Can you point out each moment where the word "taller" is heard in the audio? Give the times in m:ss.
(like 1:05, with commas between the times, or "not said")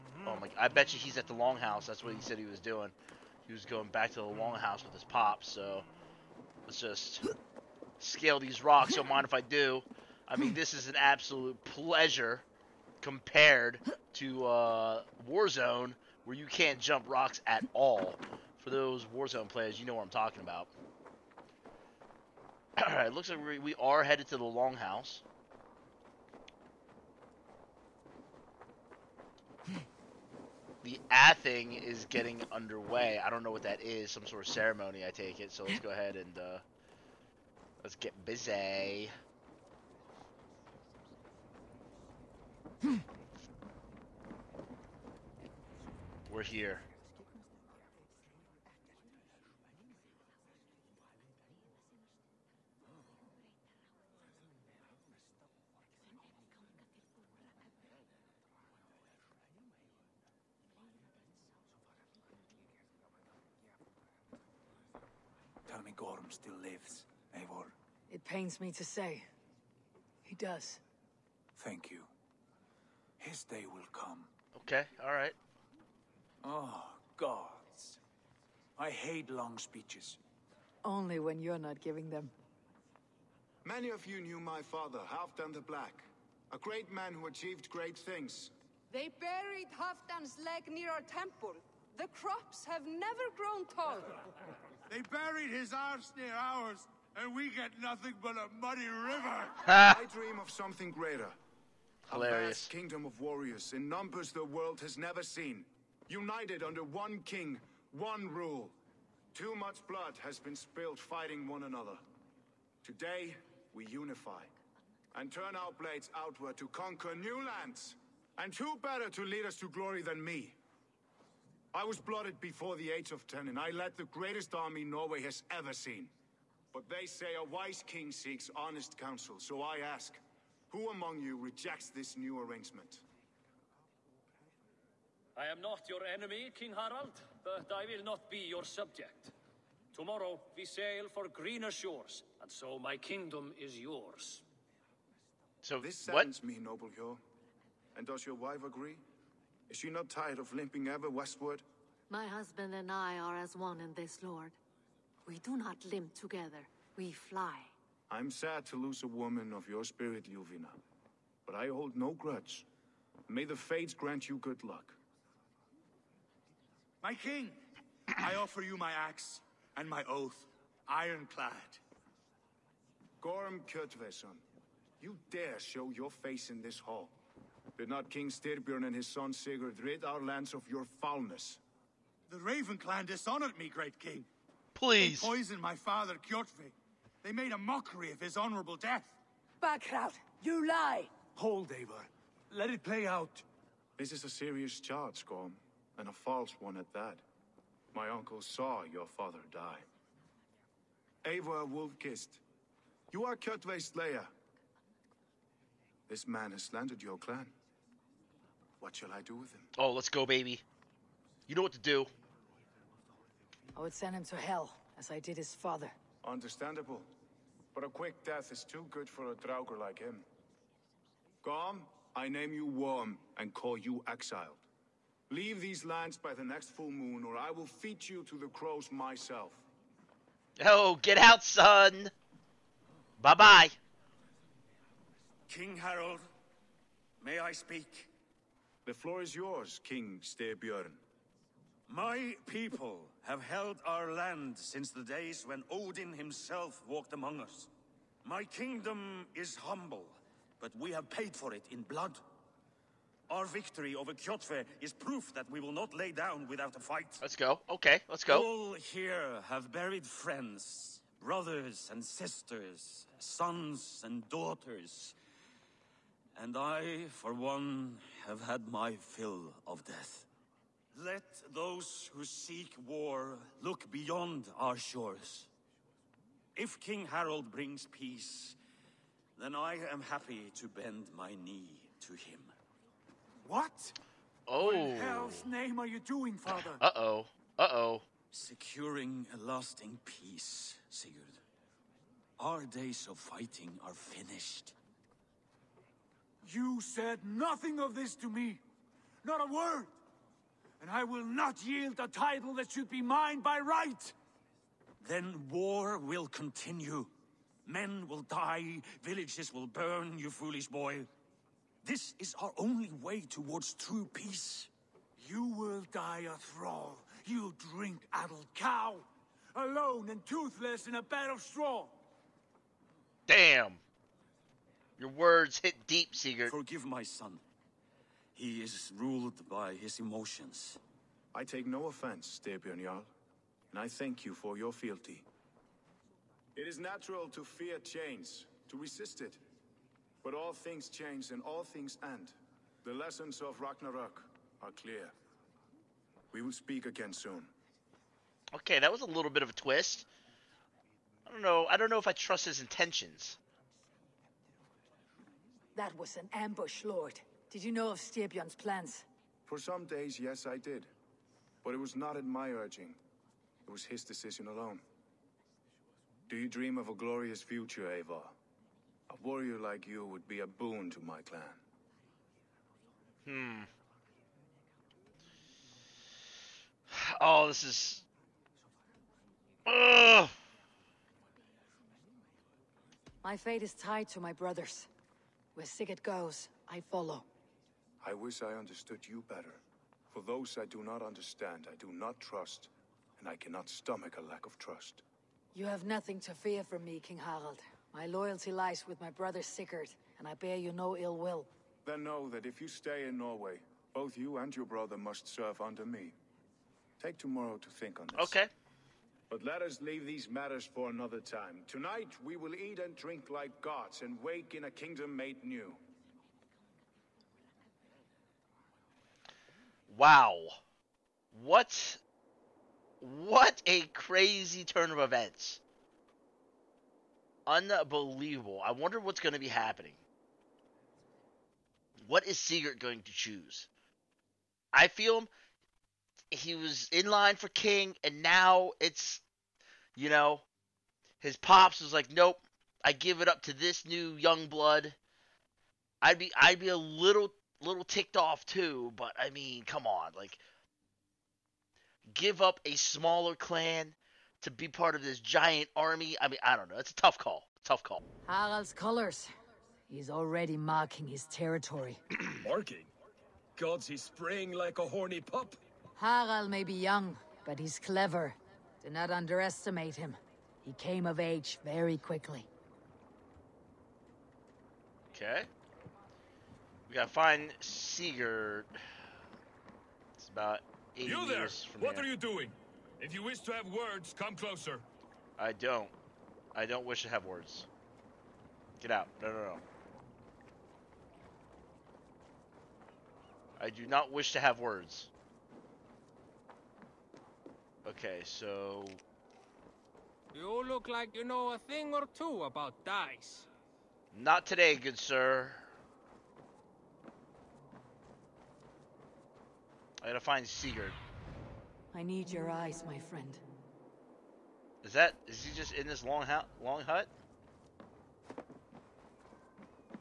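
1:33.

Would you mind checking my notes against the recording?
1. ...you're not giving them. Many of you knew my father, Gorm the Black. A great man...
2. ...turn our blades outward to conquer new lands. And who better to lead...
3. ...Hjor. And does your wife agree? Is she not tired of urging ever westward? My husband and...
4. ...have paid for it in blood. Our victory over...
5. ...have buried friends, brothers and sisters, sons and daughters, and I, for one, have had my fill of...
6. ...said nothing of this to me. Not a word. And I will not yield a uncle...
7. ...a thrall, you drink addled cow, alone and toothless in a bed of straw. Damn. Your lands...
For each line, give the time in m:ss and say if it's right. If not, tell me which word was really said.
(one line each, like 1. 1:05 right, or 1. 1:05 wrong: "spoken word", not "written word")
1. 1:21 wrong: "Halfdan", not "Gorm"
2. 1:55 right
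3. 2:26 wrong: "limping", not "urging"
4. 4:10 right
5. 4:19 right
6. 4:56 wrong: "title", not "uncle"
7. 5:16 wrong: "words", not "lands".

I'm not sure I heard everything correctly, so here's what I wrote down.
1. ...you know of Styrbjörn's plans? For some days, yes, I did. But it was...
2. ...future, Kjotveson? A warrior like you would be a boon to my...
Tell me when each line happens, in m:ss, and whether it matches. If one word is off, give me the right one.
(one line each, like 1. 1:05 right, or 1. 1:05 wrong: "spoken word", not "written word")
1. 5:57 right
2. 6:07 wrong: "Eivor", not "Kjotveson".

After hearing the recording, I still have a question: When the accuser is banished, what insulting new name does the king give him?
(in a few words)
Worm.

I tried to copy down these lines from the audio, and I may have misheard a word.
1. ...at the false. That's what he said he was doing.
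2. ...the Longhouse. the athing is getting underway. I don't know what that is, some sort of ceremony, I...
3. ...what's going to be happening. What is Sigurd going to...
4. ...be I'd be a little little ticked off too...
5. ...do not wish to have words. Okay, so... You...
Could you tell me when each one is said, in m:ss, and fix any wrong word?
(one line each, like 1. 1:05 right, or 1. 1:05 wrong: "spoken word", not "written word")
1. 0:01 wrong: "longhouse", not "false"
2. 0:24 right
3. 7:08 right
4. 7:26 right
5. 8:13 right.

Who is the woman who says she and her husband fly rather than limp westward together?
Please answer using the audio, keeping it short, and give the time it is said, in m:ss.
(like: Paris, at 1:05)
Ljuvina, at 2:40.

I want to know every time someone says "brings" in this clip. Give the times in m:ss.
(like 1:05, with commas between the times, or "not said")
4:37.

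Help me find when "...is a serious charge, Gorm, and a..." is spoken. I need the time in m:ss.
3:14.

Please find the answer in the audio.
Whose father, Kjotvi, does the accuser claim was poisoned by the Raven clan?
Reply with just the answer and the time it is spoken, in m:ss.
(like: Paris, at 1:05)
Gorm Kjotveson, at 2:53.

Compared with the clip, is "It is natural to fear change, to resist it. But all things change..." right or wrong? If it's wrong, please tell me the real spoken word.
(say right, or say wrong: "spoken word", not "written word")
right.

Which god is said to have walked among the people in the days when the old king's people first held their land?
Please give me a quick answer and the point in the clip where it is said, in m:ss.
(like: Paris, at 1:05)
Odin, at 4:05.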